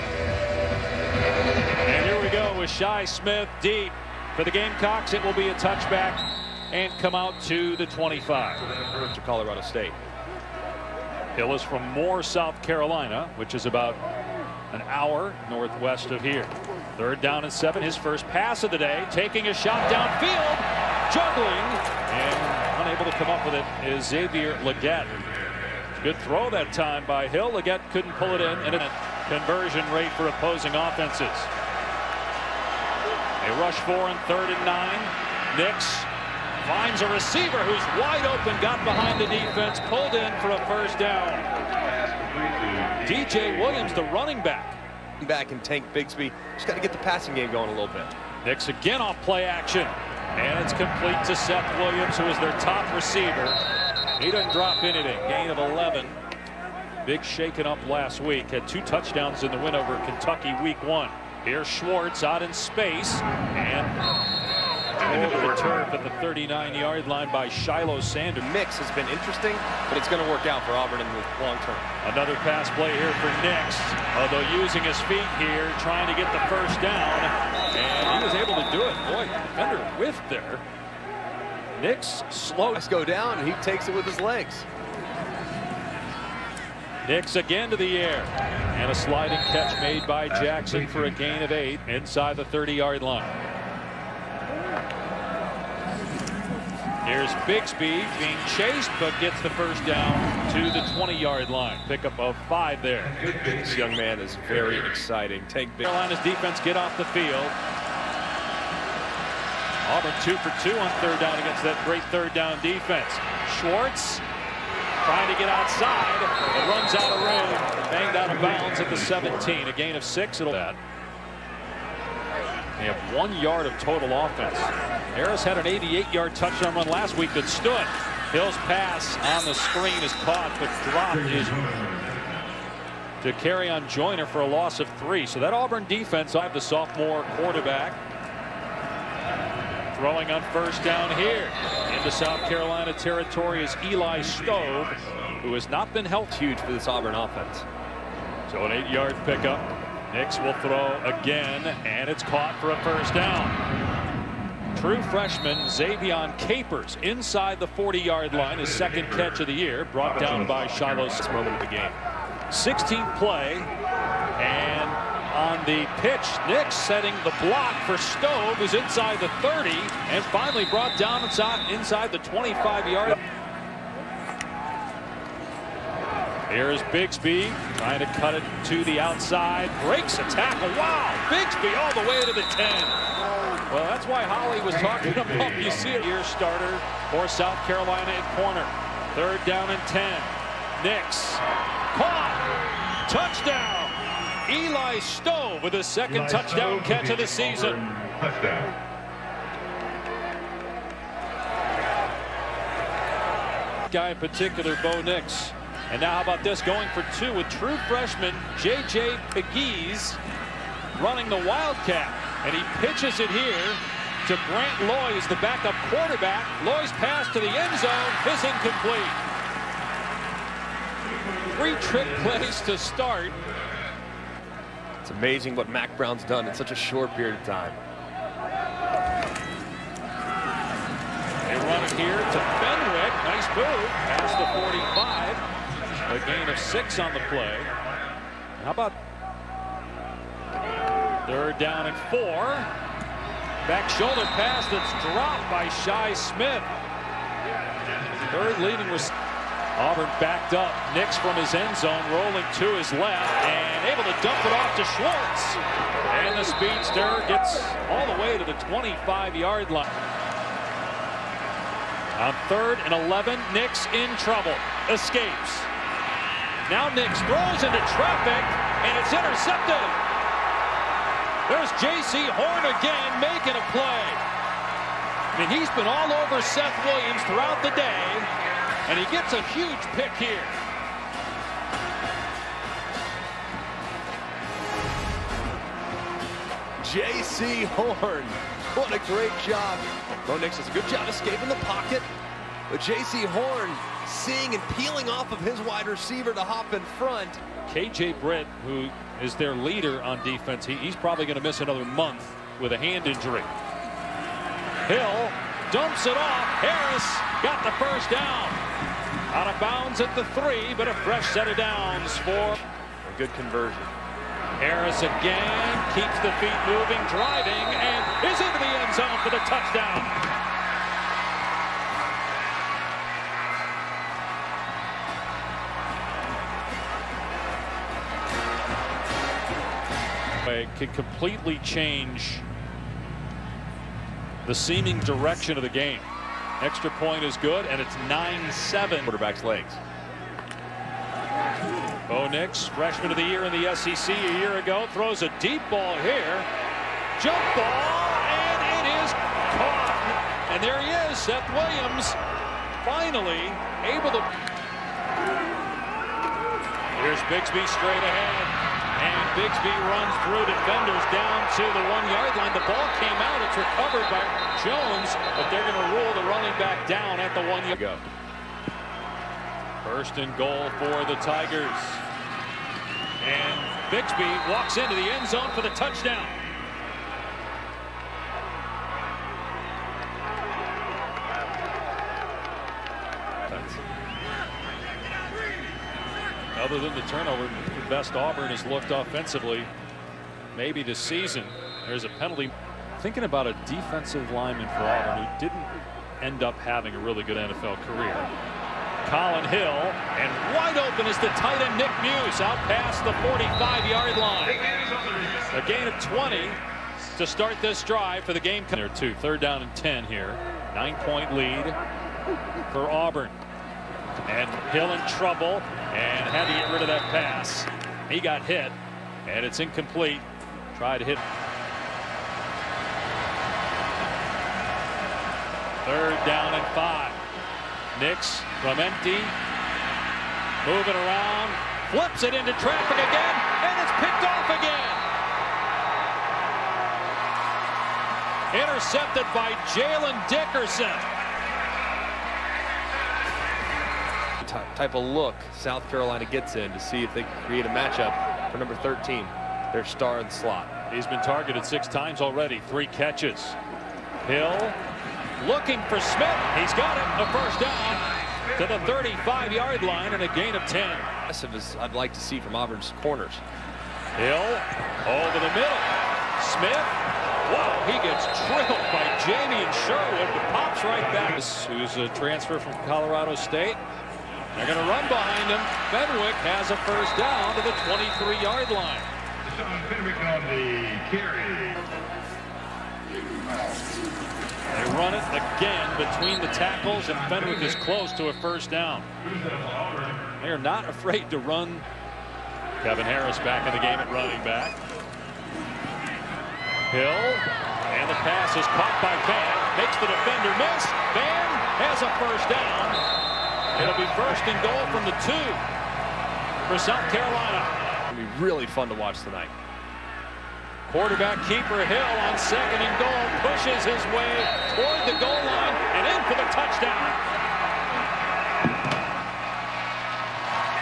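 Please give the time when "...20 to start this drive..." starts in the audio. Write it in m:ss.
6:46.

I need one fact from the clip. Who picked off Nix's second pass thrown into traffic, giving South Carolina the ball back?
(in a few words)
Jalen Dickerson.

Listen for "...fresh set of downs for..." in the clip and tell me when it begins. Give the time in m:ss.
5:10.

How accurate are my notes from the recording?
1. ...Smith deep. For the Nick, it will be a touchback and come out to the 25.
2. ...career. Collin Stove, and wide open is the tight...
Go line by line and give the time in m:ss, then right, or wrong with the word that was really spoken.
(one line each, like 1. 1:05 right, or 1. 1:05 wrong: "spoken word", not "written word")
1. 0:03 wrong: "Gamecocks", not "Nick"
2. 6:37 wrong: "Hill", not "Stove".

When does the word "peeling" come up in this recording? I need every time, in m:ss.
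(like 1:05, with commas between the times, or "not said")
4:54.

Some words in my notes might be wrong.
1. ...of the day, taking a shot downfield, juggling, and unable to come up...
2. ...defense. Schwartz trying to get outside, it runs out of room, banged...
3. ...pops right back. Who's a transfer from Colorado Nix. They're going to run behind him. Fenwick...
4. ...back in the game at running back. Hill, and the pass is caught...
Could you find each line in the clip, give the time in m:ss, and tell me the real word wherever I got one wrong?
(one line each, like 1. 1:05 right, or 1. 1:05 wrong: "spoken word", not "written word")
1. 0:18 right
2. 1:52 right
3. 7:50 wrong: "State", not "Nix"
4. 8:13 right.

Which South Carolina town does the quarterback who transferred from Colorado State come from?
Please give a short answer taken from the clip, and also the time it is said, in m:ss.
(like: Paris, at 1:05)
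Moore, South Carolina, at 0:11.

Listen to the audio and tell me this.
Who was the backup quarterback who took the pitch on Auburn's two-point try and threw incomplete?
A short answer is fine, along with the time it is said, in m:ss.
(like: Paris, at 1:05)
Grant Loy, at 3:34.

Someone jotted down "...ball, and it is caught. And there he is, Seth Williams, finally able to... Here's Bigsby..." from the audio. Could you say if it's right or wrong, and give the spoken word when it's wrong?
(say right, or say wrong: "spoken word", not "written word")
right.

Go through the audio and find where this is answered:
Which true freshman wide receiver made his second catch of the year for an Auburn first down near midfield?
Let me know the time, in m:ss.
2:35.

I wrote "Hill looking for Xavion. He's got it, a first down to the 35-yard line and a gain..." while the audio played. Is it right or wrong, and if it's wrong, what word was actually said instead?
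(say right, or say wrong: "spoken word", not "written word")
wrong: "Smith", not "Xavion".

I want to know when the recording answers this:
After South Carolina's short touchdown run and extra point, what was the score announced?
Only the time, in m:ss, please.
5:38.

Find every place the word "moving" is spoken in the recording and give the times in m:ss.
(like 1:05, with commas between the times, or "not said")
5:16, 7:10.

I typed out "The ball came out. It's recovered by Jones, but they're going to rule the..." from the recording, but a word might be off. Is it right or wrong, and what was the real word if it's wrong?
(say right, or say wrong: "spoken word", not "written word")
right.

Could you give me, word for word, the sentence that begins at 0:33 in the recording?
They rush four and third and nine.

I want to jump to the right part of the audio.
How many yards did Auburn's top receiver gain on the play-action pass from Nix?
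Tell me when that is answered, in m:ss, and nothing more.
0:55.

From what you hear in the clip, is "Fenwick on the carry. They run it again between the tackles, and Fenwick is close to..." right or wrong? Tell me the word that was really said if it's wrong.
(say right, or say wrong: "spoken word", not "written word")
right.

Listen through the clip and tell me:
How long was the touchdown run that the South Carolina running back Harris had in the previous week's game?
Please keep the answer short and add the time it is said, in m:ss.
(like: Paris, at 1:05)
88 yards, at 2:05.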